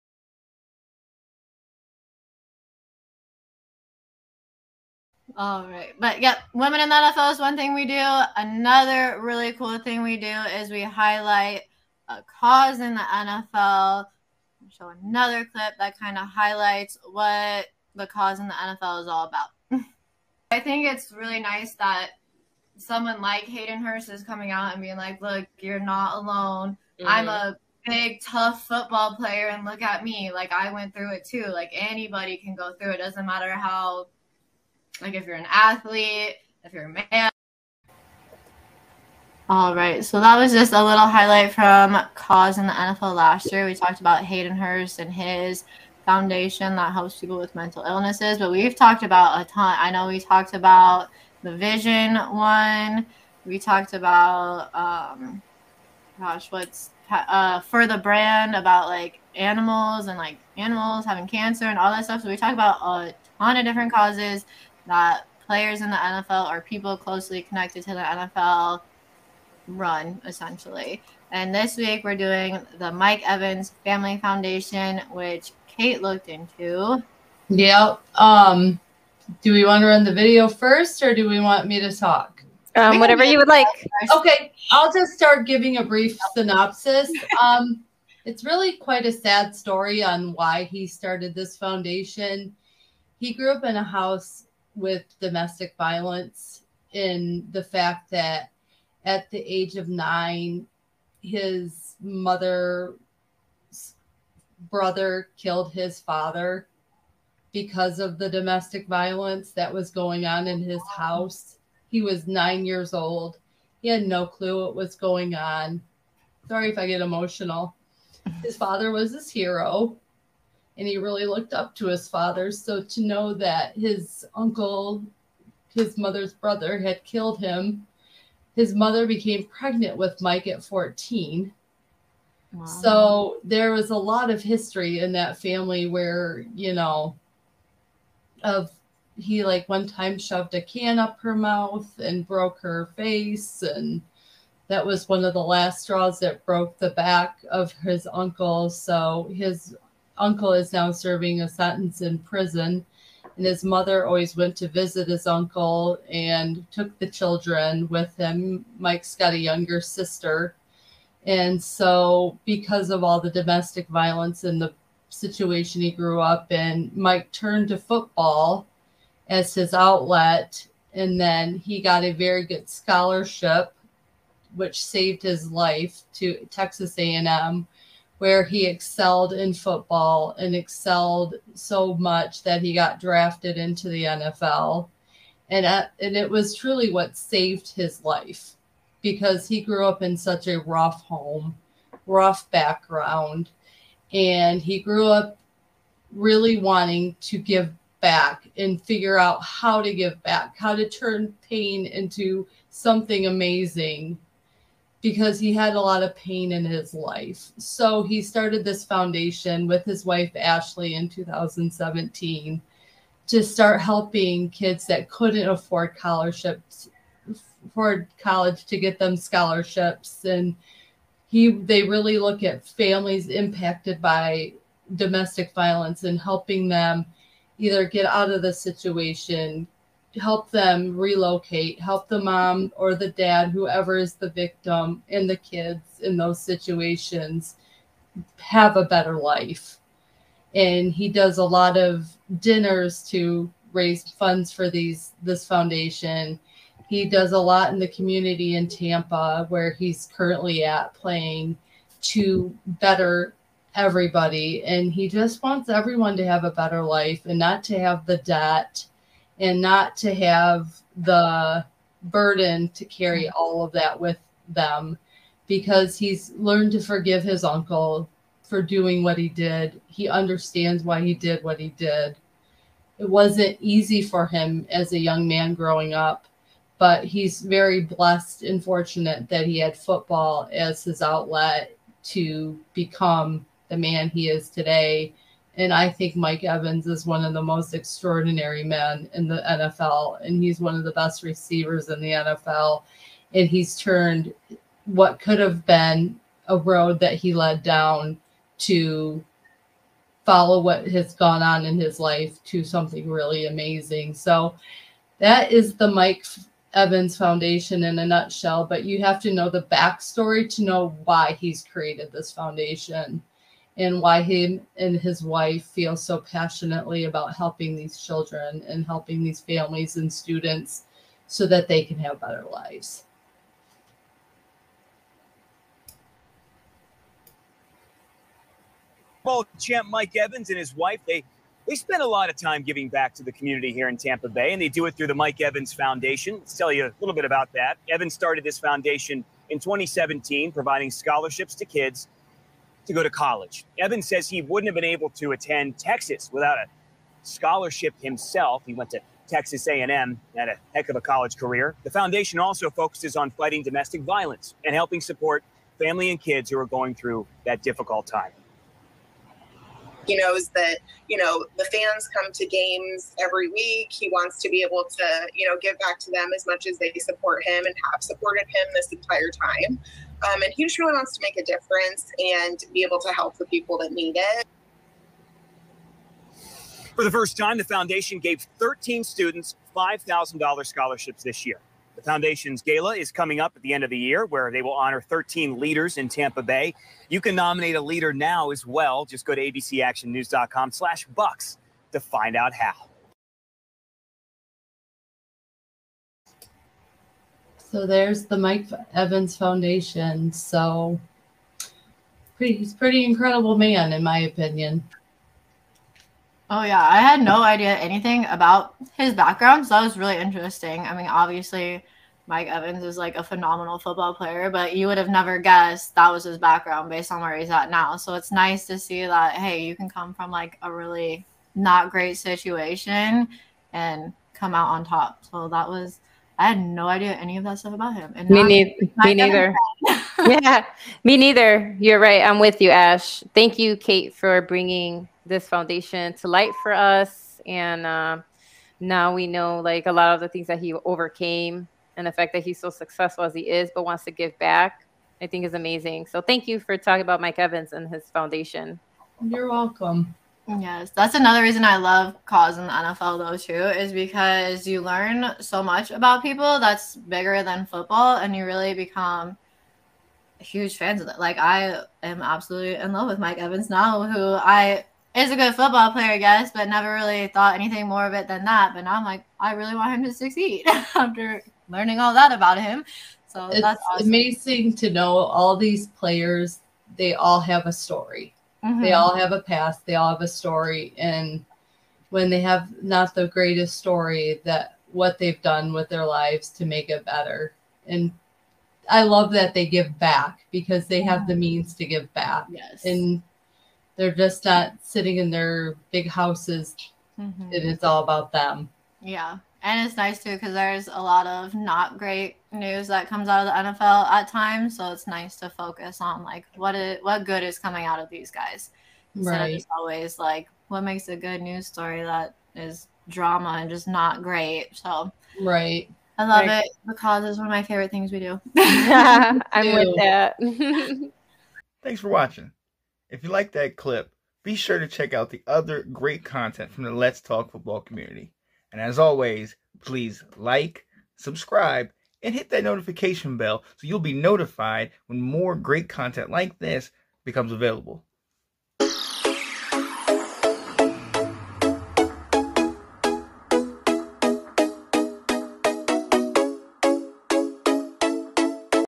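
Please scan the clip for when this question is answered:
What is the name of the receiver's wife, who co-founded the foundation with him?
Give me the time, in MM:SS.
03:30.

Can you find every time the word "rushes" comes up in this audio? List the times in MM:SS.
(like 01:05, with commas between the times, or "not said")
not said.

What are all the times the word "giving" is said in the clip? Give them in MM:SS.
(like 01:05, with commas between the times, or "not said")
01:25, 05:32.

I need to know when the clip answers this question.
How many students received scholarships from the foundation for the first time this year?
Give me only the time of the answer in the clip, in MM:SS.
06:18.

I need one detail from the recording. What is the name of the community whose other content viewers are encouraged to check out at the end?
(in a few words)
Let's Talk Football.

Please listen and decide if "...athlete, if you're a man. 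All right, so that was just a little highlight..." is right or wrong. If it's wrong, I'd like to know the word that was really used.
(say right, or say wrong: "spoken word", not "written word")
right.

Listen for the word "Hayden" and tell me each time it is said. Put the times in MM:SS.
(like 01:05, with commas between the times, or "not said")
00:23, 00:44.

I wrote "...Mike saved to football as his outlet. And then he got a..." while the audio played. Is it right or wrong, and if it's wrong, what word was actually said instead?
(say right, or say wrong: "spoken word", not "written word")
wrong: "turned", not "saved".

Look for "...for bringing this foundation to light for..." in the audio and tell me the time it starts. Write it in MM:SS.
07:14.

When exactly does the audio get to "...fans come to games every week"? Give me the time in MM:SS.
06:01.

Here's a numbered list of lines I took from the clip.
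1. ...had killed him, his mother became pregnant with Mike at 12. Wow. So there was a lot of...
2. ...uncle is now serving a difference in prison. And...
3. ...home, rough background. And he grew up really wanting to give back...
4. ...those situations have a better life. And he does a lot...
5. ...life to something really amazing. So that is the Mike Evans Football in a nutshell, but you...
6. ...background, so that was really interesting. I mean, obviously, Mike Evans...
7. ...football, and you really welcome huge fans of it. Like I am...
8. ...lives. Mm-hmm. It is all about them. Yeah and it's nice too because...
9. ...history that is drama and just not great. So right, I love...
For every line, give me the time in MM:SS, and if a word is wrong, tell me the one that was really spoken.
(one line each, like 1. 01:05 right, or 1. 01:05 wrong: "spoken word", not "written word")
1. 02:06 wrong: "14", not "12"
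2. 02:30 wrong: "sentence", not "difference"
3. 03:11 right
4. 03:56 right
5. 05:01 wrong: "Foundation", not "Football"
6. 06:49 right
7. 07:37 wrong: "become", not "welcome"
8. 08:16 wrong: "houses", not "lives"
9. 08:31 wrong: "story", not "history".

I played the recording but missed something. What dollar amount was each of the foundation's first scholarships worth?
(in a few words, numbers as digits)
$5,000.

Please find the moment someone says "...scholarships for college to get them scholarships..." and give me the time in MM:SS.
03:35.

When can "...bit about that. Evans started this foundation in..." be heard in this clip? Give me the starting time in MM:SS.
05:37.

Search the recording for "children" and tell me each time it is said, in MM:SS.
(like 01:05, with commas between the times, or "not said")
02:37, 05:17.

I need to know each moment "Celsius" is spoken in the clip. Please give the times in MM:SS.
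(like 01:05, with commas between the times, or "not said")
not said.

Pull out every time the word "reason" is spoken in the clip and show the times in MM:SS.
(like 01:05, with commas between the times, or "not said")
07:31.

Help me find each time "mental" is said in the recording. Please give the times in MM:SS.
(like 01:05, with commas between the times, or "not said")
00:47.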